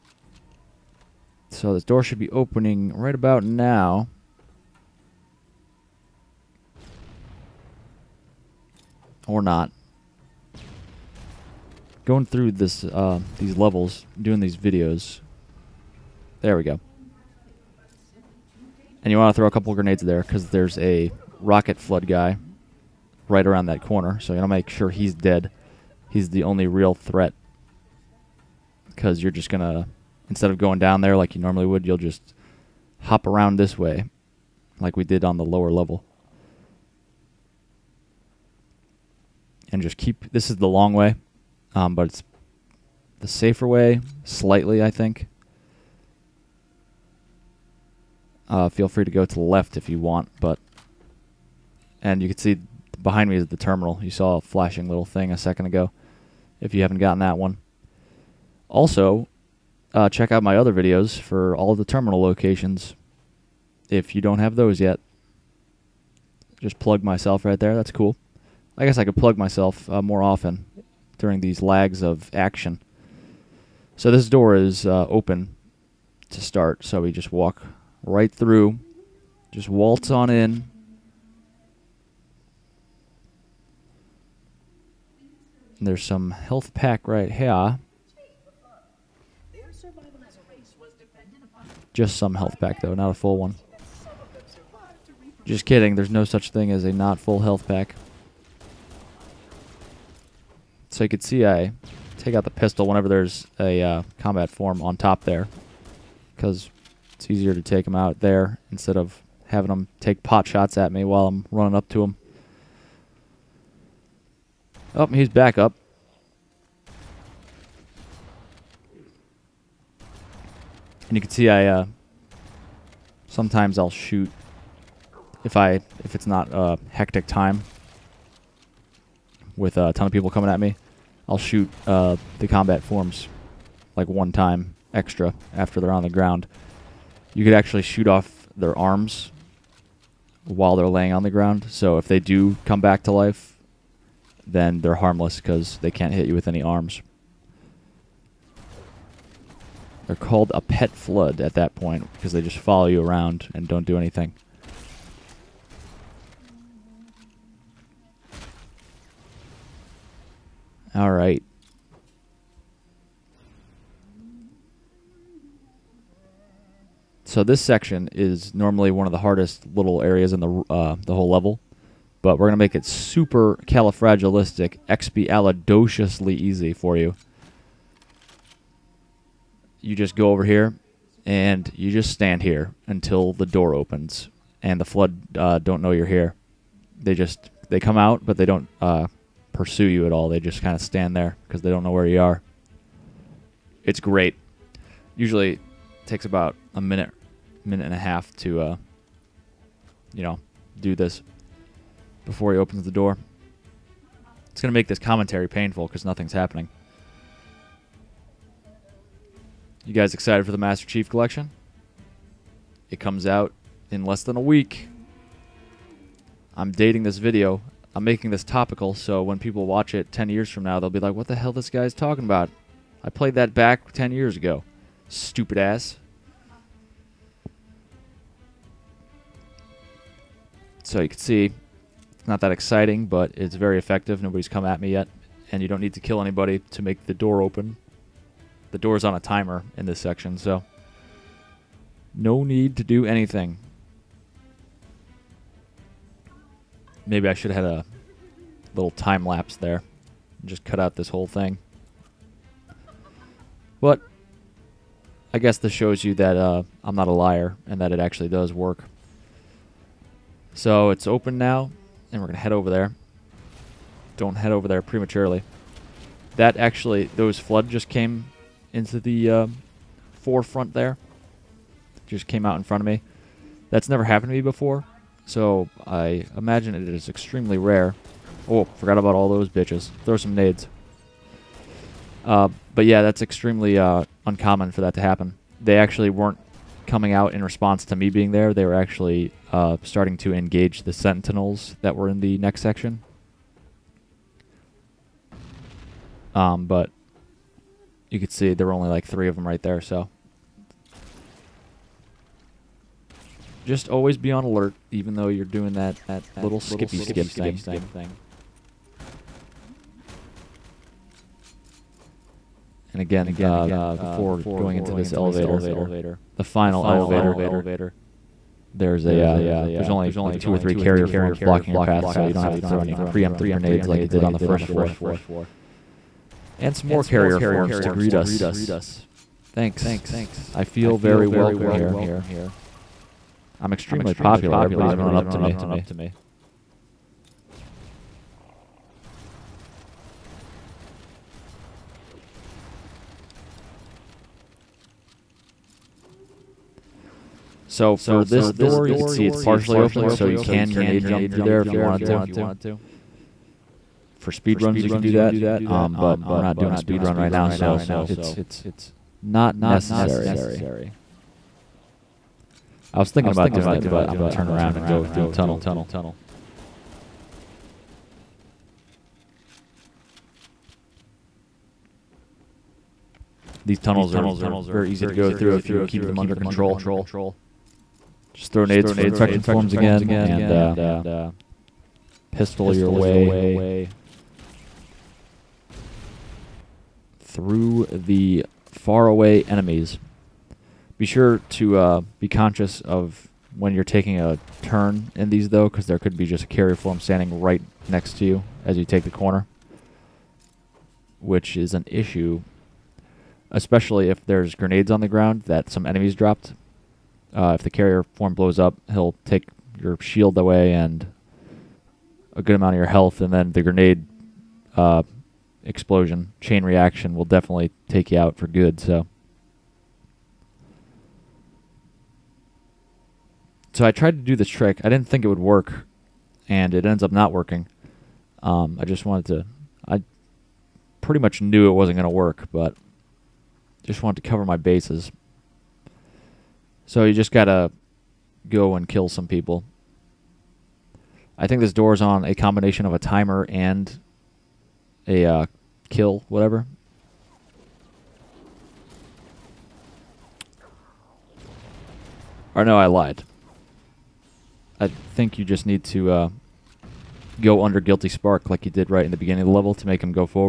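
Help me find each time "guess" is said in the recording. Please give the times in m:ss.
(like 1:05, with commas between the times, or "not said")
1:08, 4:15.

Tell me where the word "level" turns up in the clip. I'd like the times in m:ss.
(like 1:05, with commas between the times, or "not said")
0:13, 0:35, 2:51, 7:39.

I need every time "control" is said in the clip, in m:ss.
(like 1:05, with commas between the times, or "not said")
6:16.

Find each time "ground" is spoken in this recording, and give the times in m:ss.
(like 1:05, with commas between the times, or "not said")
2:16, 2:21, 6:45.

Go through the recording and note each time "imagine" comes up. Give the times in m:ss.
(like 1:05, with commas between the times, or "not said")
4:36.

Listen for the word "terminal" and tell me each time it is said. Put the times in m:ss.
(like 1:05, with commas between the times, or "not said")
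0:53, 1:01.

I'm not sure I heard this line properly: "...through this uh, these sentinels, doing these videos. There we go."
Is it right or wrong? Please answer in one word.
wrong.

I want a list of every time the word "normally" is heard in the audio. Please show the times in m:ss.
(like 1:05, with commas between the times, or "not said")
0:31, 2:48.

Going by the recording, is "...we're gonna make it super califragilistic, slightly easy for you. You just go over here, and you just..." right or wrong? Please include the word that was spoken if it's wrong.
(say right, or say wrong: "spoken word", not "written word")
wrong: "expialidociously", not "slightly".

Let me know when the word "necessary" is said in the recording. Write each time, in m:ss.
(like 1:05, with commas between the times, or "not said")
5:59.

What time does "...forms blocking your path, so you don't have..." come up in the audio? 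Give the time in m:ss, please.
5:21.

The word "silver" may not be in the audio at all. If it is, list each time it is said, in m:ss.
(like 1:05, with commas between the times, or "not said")
not said.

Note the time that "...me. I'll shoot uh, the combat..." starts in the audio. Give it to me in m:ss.
2:10.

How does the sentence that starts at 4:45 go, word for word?
They actually weren't coming out in response to me being there.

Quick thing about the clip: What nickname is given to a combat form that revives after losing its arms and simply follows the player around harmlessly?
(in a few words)
Pet flood.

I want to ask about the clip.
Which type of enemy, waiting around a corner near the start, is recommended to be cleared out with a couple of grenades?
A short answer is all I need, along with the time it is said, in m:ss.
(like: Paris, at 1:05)
Rocket flood guy, at 0:21.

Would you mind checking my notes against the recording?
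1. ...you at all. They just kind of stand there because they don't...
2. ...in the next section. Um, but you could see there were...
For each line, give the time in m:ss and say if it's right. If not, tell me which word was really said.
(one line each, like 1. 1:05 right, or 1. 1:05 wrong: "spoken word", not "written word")
1. 3:09 right
2. 4:52 right.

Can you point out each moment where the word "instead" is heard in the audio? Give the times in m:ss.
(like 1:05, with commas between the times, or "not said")
0:30, 1:48.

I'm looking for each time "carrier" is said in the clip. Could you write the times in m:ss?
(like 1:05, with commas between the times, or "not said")
5:20, 5:27, 6:36, 6:47.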